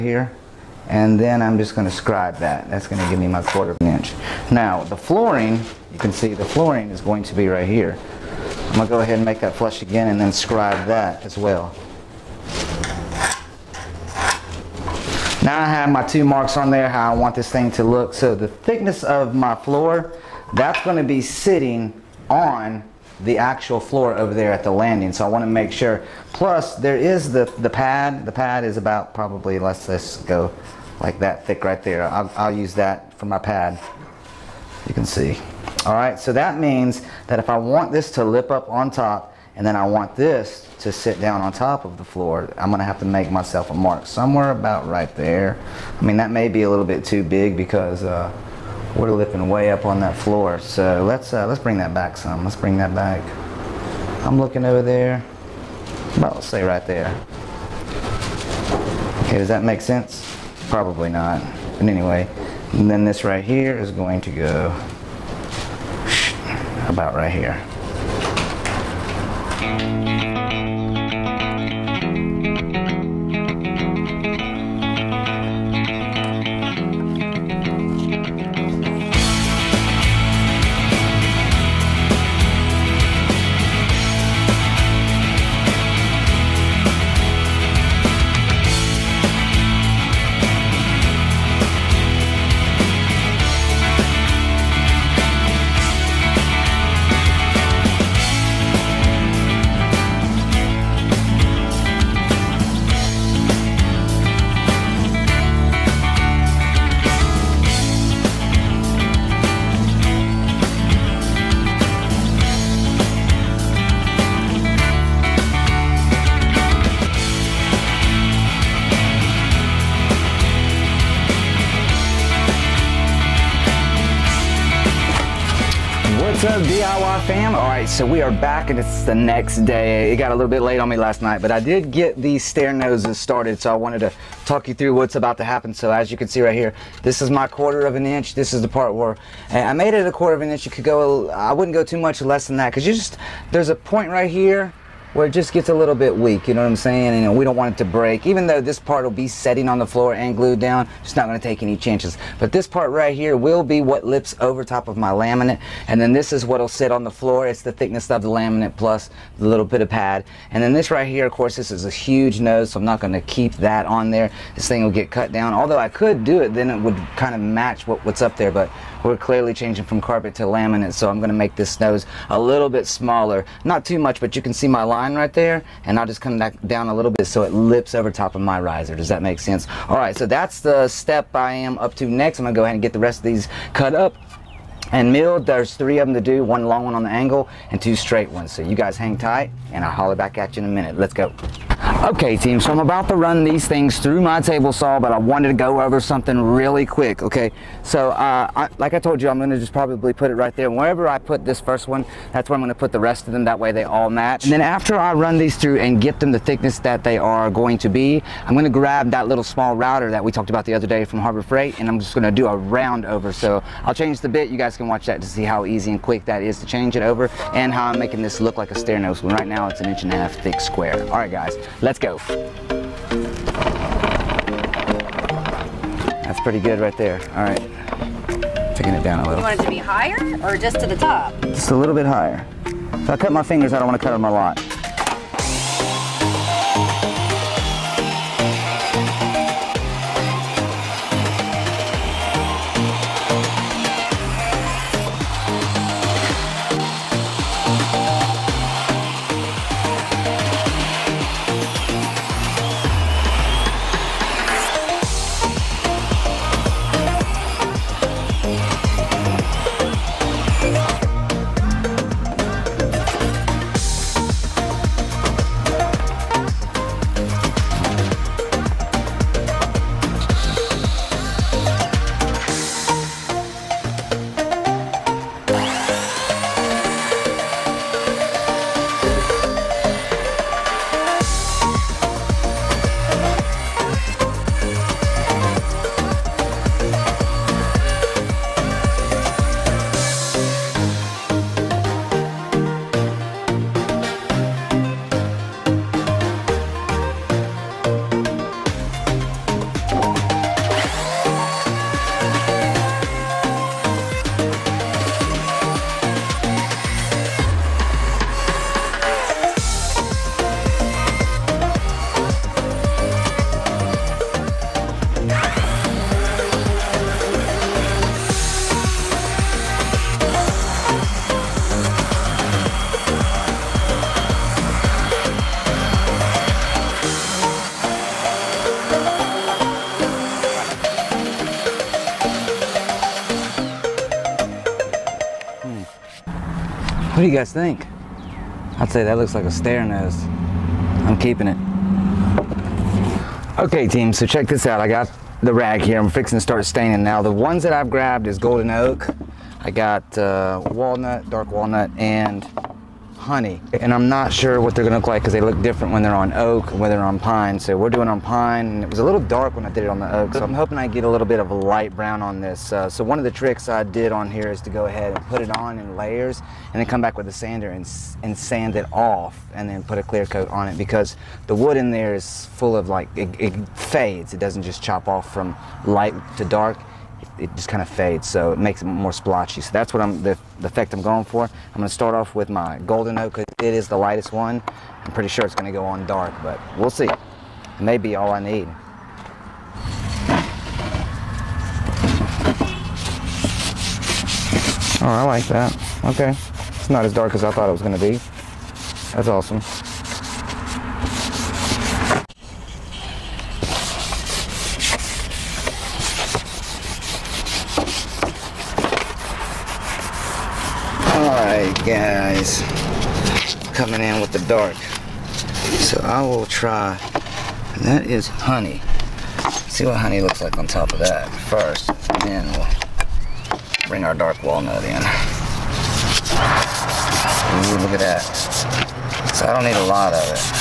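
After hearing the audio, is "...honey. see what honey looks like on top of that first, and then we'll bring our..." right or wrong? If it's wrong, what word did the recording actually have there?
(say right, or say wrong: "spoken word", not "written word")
right.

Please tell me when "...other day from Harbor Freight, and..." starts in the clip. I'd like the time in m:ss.
3:30.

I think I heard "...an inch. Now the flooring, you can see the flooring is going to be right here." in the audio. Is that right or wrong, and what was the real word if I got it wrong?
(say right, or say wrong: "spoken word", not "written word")
right.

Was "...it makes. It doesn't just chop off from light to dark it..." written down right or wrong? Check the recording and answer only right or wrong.
wrong.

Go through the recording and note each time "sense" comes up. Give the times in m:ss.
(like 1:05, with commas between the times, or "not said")
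0:59, 2:59.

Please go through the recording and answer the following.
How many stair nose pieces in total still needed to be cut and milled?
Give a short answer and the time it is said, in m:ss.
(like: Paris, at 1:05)
3, at 3:05.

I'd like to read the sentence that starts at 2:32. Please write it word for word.
But this part right here will be what lips over top of my laminate.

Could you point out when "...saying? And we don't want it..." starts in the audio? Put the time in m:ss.
2:26.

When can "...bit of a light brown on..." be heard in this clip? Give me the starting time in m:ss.
6:01.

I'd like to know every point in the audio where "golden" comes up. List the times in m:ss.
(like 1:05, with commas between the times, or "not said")
5:48, 6:22.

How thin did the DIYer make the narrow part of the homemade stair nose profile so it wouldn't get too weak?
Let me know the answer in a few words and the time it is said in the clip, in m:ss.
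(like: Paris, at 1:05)
a quarter of an inch, at 2:20.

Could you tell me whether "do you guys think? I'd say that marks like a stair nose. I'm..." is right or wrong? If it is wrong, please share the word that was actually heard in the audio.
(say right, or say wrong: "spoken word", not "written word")
wrong: "looks", not "marks".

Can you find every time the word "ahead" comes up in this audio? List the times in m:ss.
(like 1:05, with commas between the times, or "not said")
0:09, 3:02, 6:04.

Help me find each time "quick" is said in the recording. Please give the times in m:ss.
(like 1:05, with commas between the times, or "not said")
3:16, 3:36.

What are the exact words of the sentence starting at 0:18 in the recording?
So the thickness of my floor, that's going to be sitting on the actual floor over there at the landing.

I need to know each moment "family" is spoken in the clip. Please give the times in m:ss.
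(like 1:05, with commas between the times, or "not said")
not said.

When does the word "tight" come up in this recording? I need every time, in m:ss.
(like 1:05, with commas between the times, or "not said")
3:09.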